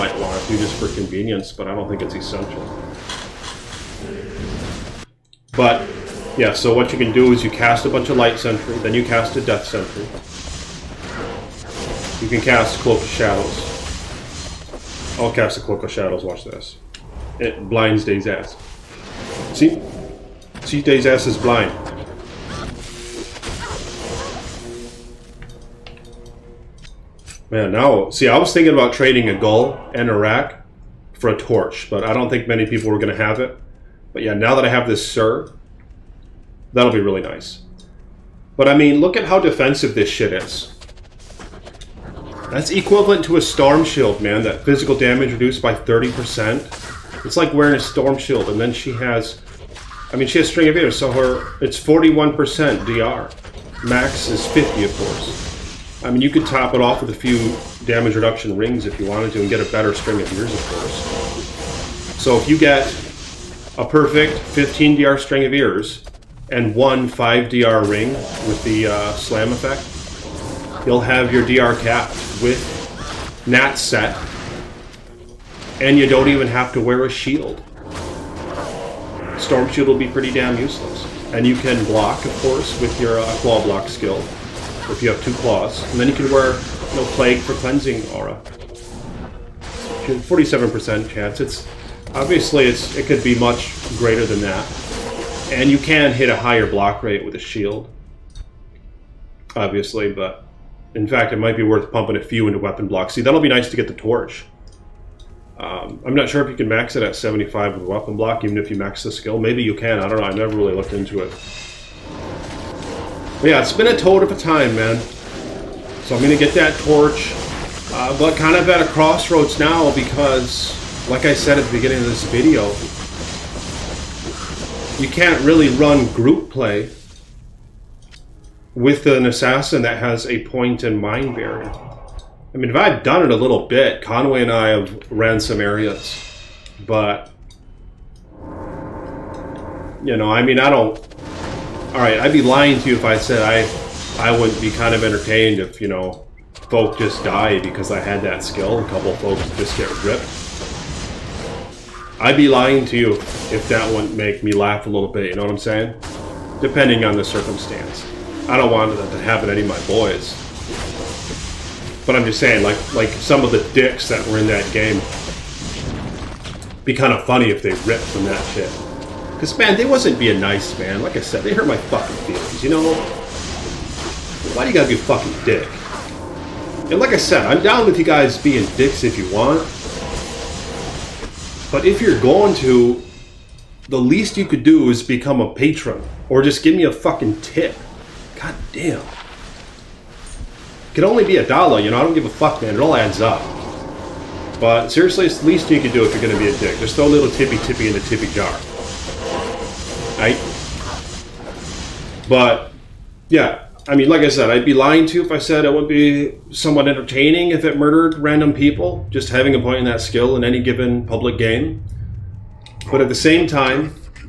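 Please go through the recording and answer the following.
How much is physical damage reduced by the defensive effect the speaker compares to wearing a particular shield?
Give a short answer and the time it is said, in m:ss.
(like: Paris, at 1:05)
30%, at 0:45.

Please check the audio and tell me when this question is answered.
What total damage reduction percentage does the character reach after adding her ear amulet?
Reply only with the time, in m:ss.
0:51.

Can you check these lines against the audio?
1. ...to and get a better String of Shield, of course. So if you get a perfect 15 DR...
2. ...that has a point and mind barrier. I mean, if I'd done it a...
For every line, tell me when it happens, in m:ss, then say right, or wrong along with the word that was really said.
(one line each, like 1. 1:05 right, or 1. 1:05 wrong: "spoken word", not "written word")
1. 0:59 wrong: "Ears", not "Shield"
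2. 2:09 right.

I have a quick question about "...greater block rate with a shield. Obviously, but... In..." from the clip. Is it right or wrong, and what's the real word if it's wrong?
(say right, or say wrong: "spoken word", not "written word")
wrong: "higher", not "greater".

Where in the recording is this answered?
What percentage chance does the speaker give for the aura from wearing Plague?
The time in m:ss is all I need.
1:29.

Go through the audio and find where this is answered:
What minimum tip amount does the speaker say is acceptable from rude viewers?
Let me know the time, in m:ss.
3:11.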